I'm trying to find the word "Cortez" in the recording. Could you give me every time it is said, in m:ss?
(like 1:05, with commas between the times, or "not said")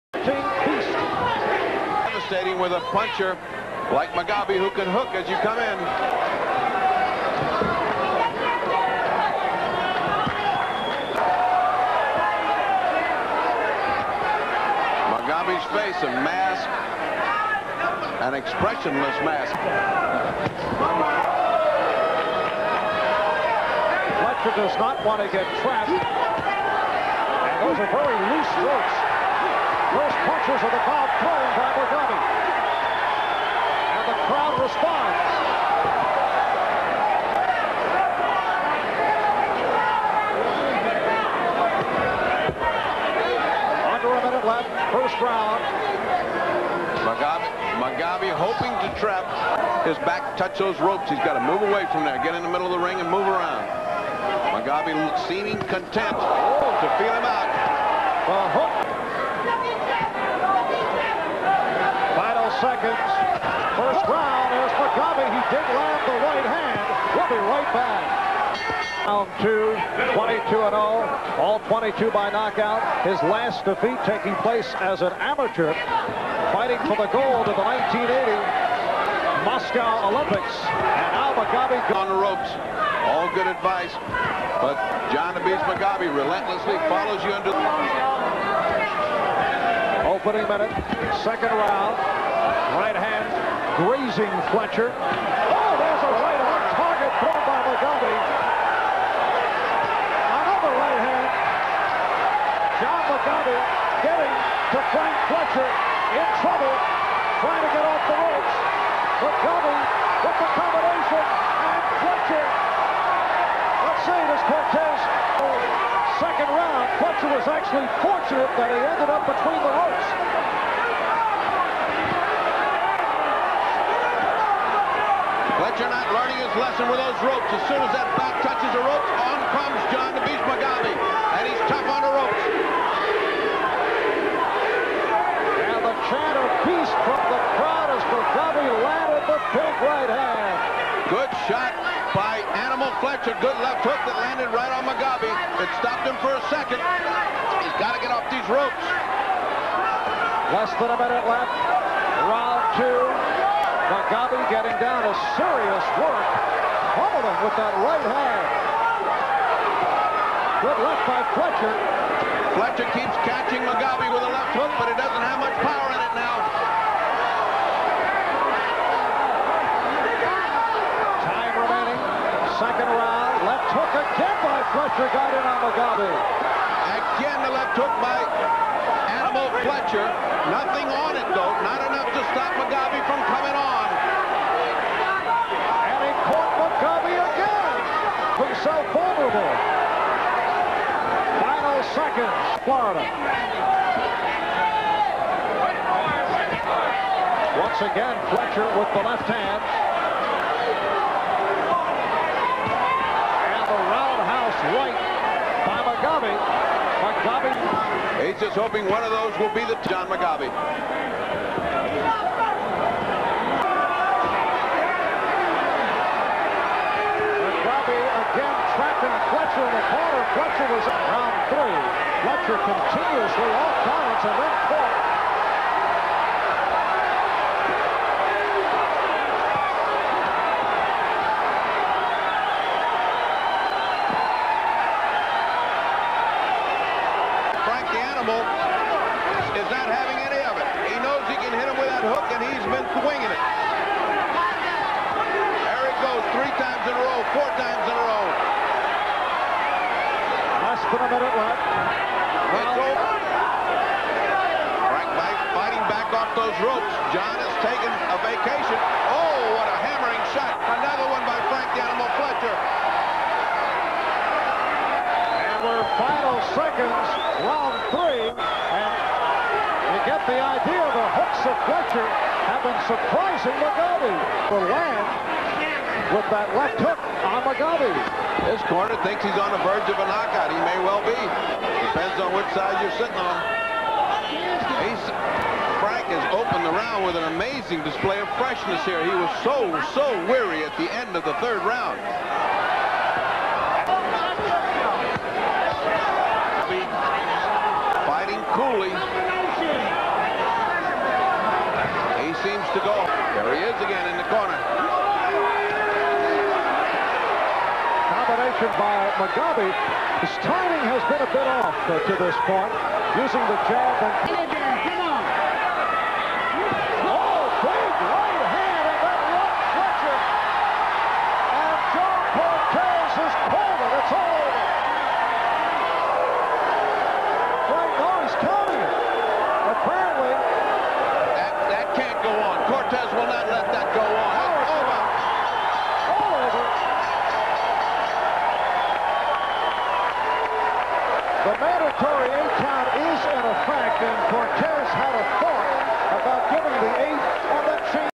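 1:54, 5:44.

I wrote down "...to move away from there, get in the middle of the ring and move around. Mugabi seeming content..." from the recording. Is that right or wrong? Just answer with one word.
right.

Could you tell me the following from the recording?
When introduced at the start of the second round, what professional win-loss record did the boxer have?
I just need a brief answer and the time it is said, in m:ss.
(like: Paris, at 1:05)
22 and 0, at 1:10.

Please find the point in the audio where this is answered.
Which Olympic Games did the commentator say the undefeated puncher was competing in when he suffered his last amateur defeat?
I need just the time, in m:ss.
1:17.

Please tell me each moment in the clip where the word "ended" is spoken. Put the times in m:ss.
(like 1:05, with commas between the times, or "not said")
1:58.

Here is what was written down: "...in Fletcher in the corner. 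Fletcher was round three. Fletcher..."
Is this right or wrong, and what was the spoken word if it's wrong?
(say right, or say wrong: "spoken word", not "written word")
right.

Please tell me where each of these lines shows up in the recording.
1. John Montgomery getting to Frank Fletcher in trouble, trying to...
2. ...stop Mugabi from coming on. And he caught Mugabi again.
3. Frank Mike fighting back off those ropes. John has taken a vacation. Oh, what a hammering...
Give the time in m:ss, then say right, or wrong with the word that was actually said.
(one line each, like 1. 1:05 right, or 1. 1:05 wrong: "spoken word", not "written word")
1. 1:42 right
2. 3:02 right
3. 4:14 right.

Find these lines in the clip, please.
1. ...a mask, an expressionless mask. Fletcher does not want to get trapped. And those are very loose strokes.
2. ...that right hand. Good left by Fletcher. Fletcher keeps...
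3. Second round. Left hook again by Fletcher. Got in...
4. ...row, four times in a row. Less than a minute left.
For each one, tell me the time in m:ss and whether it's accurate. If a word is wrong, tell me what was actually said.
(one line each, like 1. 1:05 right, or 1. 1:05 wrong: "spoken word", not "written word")
1. 0:16 right
2. 2:37 right
3. 2:52 right
4. 4:07 right.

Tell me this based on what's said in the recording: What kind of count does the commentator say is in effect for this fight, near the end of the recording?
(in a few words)
mandatory eight count.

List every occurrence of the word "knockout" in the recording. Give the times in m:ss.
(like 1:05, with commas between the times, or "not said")
1:12, 4:40.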